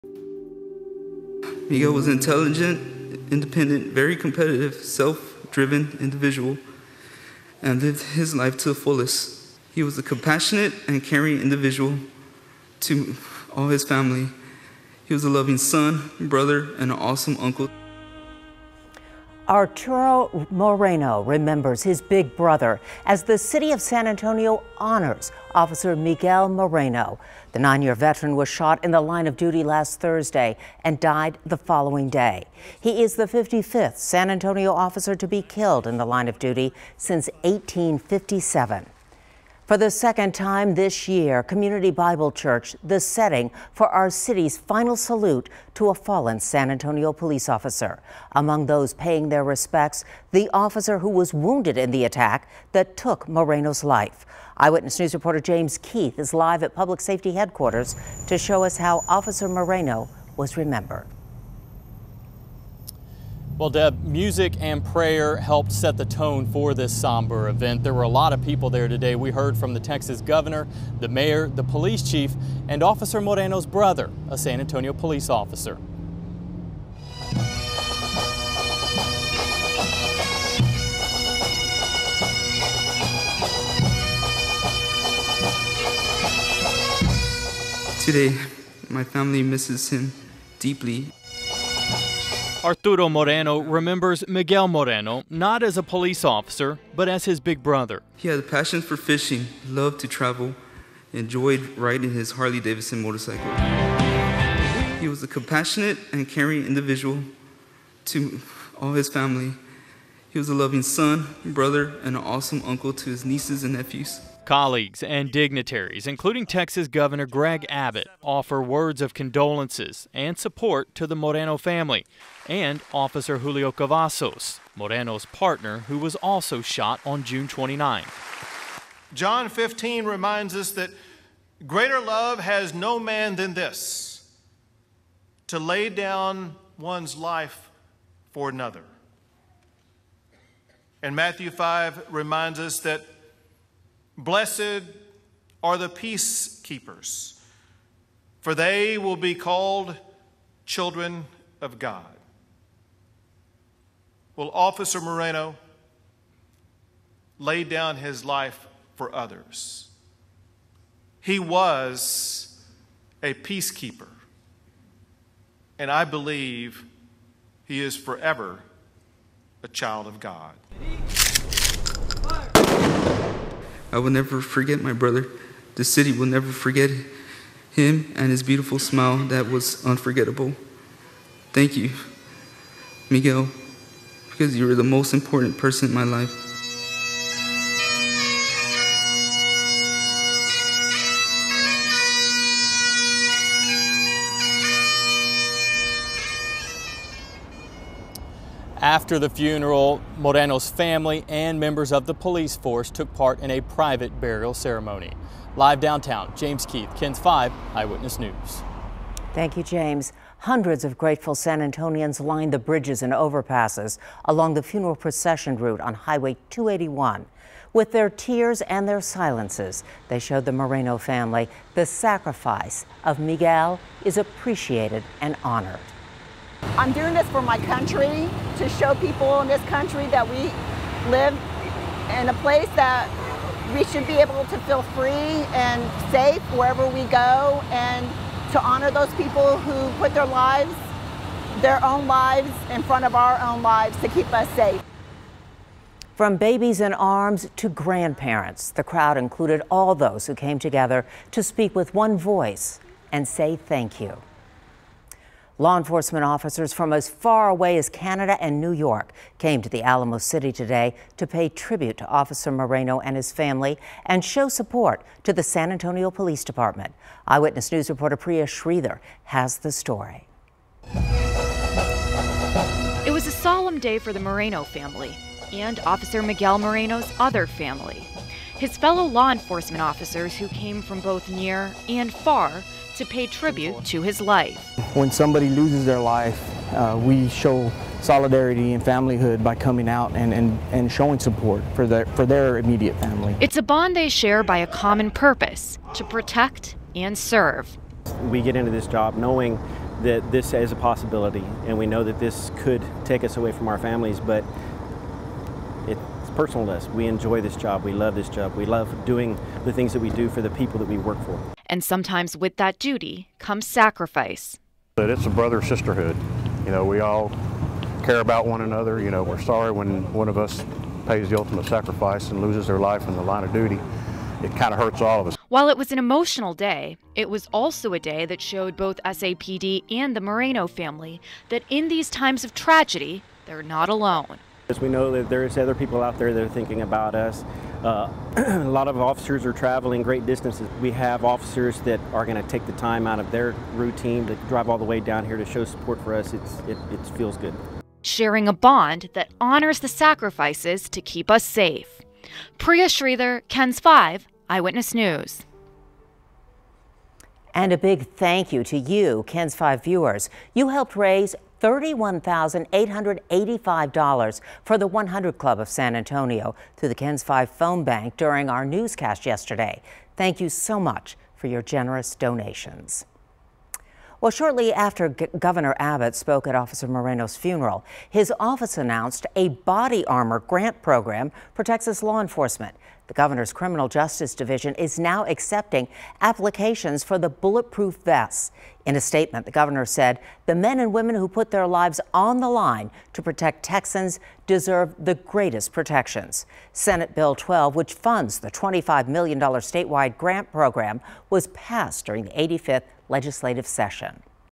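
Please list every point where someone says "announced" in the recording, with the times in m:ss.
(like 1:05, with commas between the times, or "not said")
6:18.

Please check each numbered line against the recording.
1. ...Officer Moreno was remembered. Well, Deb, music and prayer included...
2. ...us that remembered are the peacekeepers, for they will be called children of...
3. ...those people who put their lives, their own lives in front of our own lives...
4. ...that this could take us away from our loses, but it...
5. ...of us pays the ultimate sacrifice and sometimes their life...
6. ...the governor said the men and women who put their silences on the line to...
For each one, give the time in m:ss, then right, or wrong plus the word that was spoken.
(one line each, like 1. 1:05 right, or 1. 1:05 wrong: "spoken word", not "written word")
1. 0:59 wrong: "helped", not "included"
2. 2:22 wrong: "blessed", not "remembered"
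3. 3:58 right
4. 5:02 wrong: "families", not "loses"
5. 5:20 wrong: "loses", not "sometimes"
6. 6:29 wrong: "lives", not "silences".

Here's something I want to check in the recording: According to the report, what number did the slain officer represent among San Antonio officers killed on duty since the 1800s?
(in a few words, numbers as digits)
55th.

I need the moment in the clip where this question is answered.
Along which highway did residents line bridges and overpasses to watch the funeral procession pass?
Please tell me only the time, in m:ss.
3:35.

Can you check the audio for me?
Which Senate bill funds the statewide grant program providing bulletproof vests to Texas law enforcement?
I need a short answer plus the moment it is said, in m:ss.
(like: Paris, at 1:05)
Senate Bill 12, at 6:36.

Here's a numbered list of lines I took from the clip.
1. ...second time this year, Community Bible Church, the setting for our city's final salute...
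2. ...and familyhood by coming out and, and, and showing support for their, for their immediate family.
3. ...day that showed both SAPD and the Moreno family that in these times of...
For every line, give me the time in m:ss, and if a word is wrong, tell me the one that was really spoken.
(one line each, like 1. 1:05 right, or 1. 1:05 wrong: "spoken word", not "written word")
1. 0:39 right
2. 4:48 right
3. 5:27 right.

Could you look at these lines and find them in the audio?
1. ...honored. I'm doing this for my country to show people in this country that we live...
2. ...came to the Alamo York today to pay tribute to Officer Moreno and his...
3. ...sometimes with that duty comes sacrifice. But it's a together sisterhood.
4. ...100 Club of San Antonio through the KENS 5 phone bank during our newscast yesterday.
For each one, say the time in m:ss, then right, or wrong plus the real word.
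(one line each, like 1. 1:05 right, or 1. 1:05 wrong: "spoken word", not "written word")
1. 3:45 right
2. 4:19 wrong: "City", not "York"
3. 5:11 wrong: "brother", not "together"
4. 6:04 right.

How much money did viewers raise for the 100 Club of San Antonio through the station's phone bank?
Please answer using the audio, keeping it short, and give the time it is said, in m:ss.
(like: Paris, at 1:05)
$31,885, at 6:01.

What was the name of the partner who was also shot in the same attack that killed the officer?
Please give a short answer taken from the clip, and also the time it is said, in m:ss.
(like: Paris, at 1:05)
Julio Cavazos, at 2:03.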